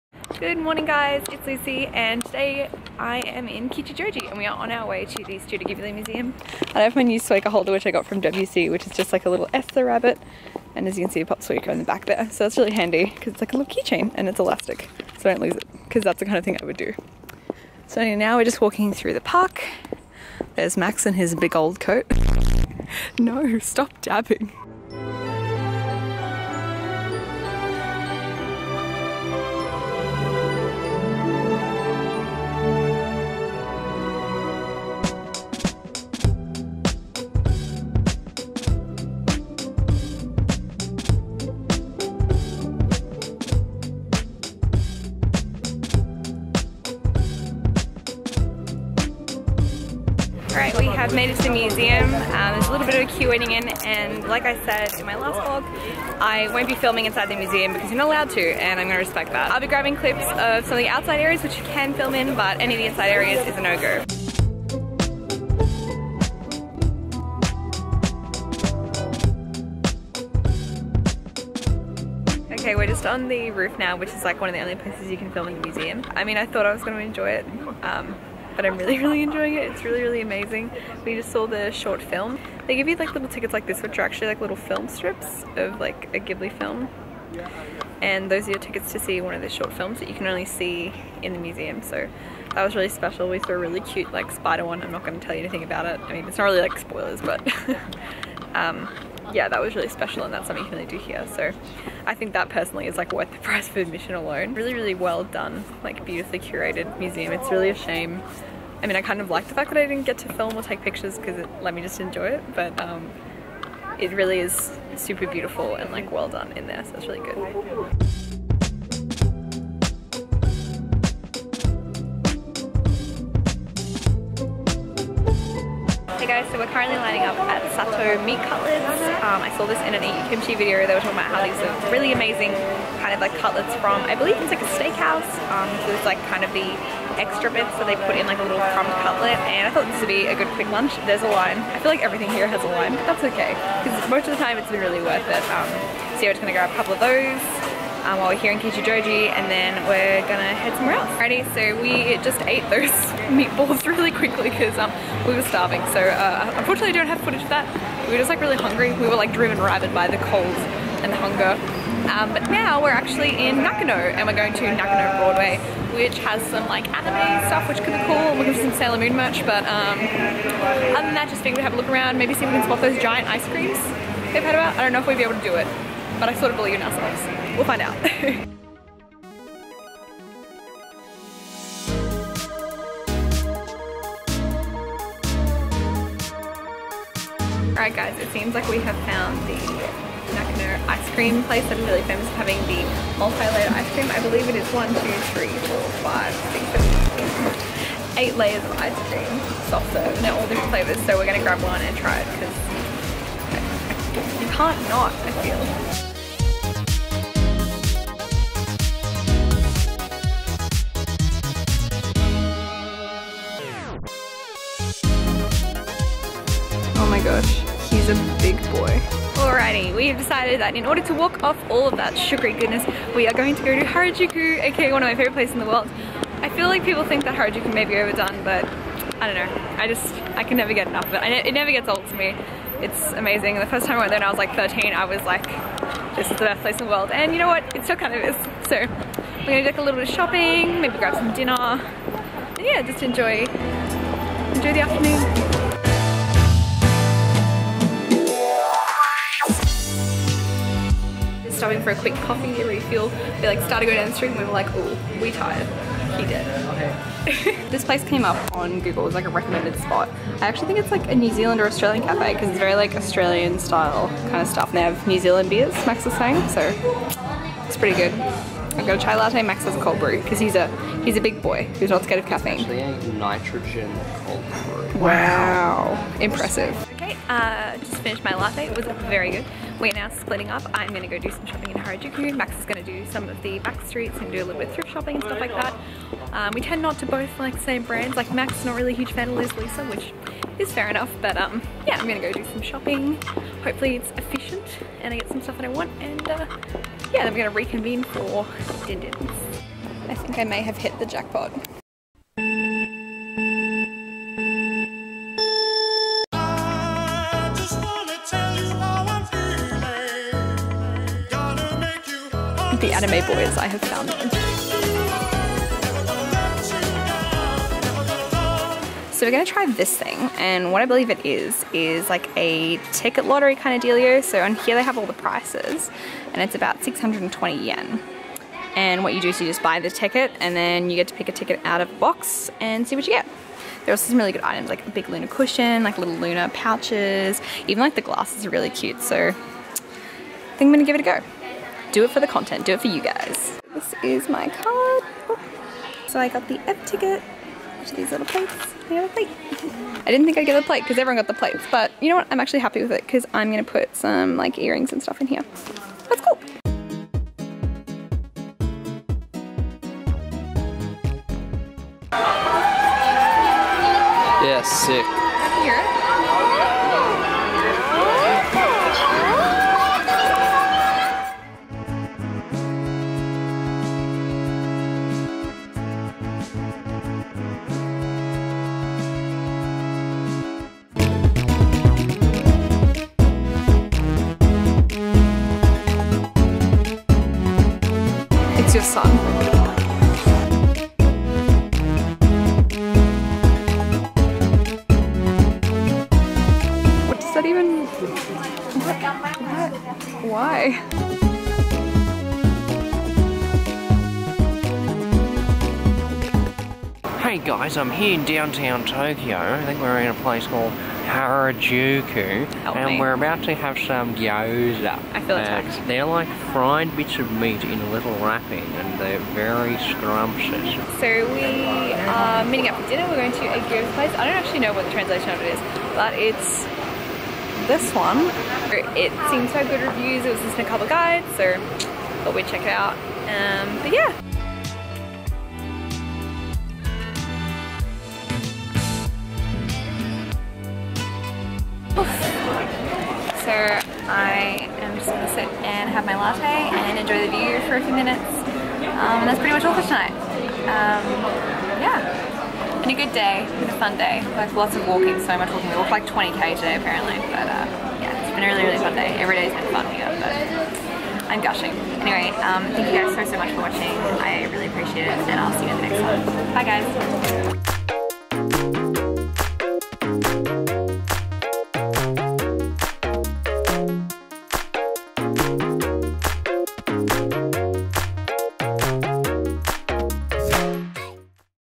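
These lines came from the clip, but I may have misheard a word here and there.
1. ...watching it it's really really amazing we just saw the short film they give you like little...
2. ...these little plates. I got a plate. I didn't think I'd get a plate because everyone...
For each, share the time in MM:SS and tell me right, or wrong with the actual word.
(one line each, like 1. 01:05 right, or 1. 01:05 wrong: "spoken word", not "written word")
1. 01:19 wrong: "enjoying", not "watching"
2. 05:47 right.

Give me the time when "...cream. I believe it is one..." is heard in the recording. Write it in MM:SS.
03:13.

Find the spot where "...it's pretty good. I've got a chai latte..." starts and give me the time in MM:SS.
04:27.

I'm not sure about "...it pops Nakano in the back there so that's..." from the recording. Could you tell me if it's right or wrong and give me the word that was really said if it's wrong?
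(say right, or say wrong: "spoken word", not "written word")
wrong: "Suika", not "Nakano".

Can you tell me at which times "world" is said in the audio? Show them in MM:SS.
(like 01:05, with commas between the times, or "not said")
03:45, 03:56.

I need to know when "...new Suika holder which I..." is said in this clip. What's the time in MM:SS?
00:07.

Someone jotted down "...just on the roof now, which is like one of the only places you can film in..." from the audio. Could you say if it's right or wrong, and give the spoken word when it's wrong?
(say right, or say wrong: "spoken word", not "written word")
right.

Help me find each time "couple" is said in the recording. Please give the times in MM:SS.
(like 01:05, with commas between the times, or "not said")
02:26, 07:10.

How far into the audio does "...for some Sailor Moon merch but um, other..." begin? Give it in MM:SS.
02:48.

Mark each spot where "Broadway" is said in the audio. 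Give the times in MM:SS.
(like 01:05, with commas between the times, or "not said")
02:45.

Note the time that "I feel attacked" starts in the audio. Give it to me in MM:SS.
06:55.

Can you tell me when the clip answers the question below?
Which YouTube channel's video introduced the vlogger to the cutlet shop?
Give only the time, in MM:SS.
02:09.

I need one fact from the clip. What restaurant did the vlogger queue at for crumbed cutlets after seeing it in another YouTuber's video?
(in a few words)
Sato Meat Cutlets.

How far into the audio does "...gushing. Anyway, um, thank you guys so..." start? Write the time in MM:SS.
07:41.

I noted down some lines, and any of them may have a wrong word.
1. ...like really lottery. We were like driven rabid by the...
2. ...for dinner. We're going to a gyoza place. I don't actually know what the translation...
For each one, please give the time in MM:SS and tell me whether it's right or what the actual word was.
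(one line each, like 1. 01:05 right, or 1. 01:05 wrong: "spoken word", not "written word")
1. 02:38 wrong: "hungry", not "lottery"
2. 07:02 right.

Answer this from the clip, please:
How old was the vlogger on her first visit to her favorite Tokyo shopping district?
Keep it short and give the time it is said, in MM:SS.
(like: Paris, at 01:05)
13, at 03:54.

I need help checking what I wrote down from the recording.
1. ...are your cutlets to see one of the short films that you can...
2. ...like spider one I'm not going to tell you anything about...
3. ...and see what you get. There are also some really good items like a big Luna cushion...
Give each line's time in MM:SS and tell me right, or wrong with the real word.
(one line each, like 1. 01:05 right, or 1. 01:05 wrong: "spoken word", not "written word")
1. 01:28 wrong: "tickets", not "cutlets"
2. 01:34 right
3. 05:32 right.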